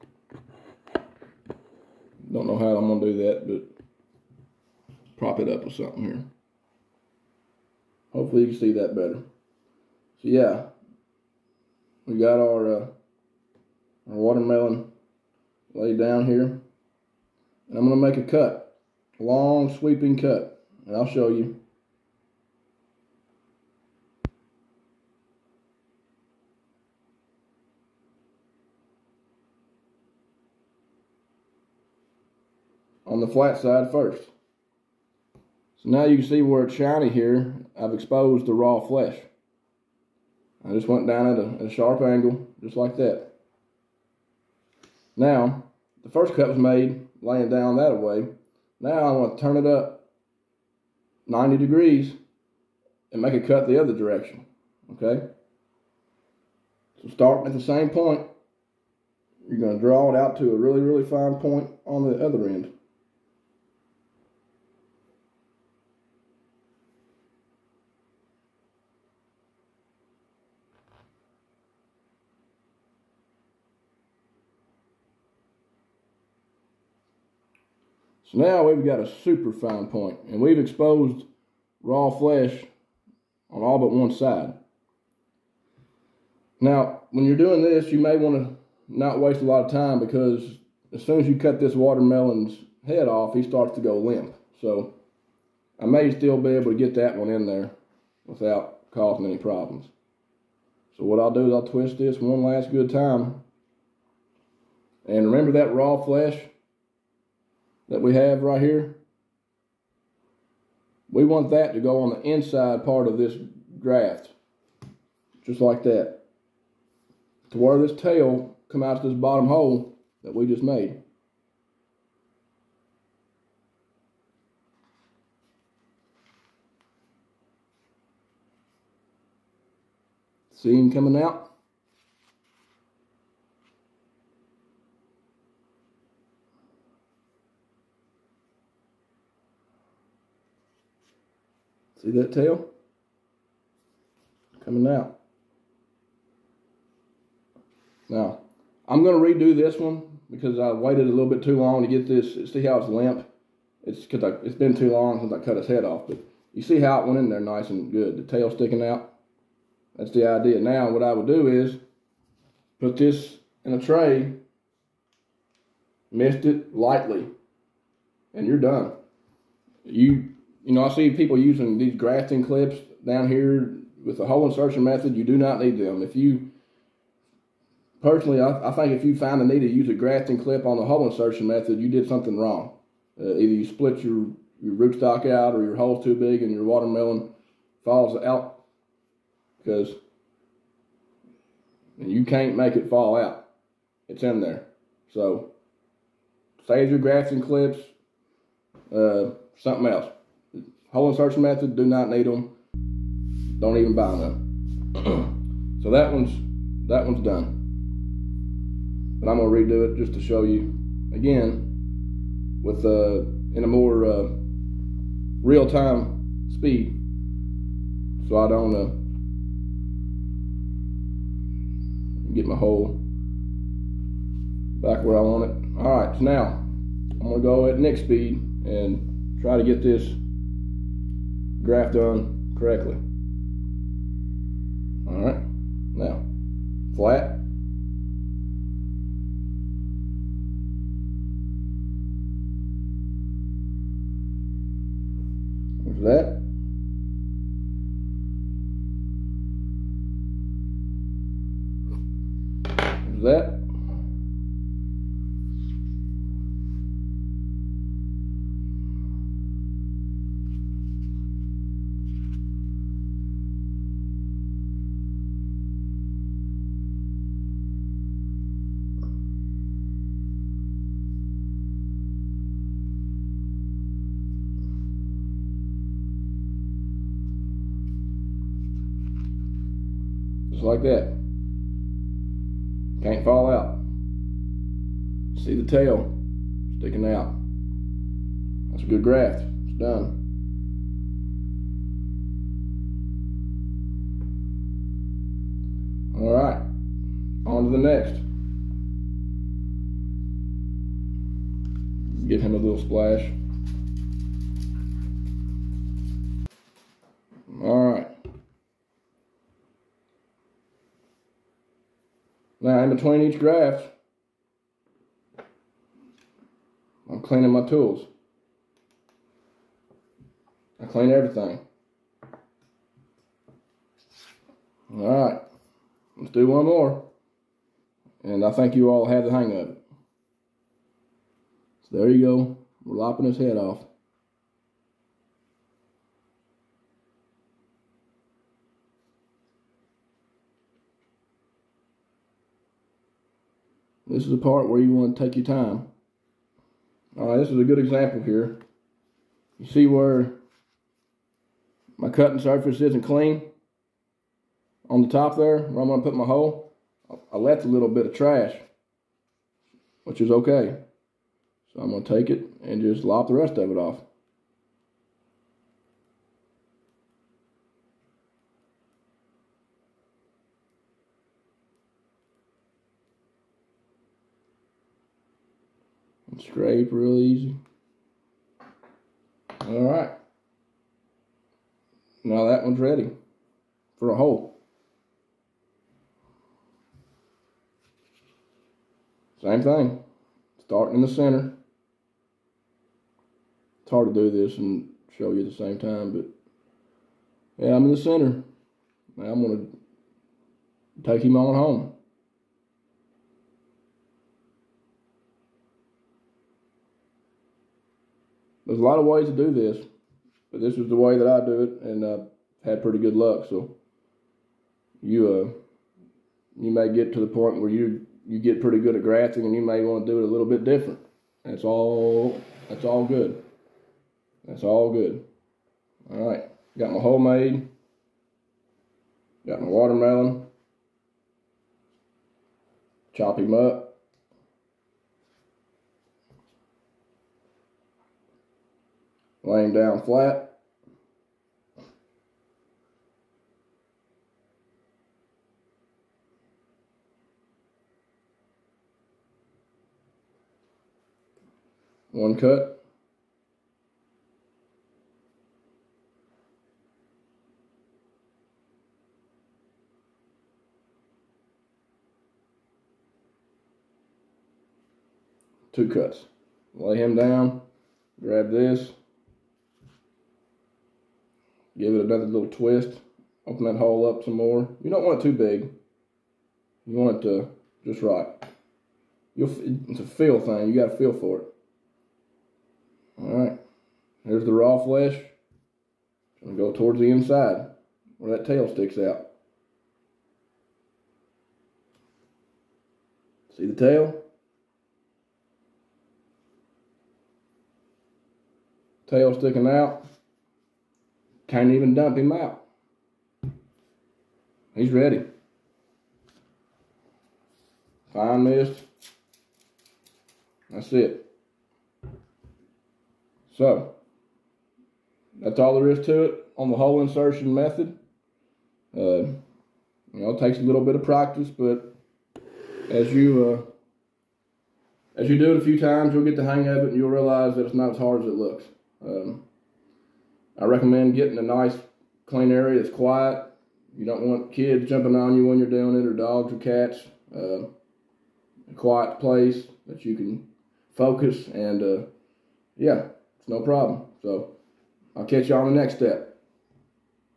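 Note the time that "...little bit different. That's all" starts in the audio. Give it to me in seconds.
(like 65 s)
420 s.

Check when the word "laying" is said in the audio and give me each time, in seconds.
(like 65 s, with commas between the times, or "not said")
47 s, 439 s.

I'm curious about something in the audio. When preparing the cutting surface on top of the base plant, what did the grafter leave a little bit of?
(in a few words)
trash.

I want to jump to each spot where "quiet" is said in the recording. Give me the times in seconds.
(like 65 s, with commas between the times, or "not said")
532 s, 538 s.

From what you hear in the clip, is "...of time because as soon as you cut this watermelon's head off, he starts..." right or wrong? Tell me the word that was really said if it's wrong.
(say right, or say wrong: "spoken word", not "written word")
right.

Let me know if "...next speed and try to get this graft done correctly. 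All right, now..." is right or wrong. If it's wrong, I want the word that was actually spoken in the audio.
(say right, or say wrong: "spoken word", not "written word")
right.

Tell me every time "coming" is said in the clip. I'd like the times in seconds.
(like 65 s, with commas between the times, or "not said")
130 s, 144 s.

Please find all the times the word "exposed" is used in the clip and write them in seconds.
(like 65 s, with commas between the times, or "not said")
37 s, 80 s.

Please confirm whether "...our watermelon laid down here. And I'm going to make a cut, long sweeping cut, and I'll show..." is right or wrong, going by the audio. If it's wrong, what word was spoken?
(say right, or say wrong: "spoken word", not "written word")
right.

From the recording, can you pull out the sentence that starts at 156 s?
But you see how it went in there nice and good.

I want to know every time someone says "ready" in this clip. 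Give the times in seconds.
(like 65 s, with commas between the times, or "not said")
382 s, 504 s.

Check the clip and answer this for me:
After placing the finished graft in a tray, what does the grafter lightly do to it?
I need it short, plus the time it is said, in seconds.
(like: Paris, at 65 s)
mist it, at 166 s.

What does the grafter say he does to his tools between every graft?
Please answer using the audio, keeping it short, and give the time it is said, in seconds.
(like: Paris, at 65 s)
cleaning, at 317 s.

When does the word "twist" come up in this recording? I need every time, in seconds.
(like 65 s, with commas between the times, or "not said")
101 s, 472 s.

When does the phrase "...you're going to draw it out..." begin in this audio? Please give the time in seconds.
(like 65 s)
59 s.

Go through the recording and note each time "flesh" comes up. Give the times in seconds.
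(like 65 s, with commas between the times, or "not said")
38 s, 82 s, 106 s, 484 s.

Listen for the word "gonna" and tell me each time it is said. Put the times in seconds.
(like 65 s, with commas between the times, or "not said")
209 s, 227 s.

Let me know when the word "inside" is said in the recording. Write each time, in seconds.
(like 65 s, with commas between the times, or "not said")
112 s, 487 s.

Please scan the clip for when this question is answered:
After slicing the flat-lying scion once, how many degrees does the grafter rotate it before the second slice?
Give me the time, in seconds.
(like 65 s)
51 s.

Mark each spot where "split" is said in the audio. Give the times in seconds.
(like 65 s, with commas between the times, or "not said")
183 s.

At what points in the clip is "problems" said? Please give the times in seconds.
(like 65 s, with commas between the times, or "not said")
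99 s, 543 s.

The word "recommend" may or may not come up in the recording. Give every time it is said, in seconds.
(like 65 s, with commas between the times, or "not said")
530 s.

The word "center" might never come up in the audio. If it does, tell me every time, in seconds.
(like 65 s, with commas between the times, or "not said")
391 s, 397 s.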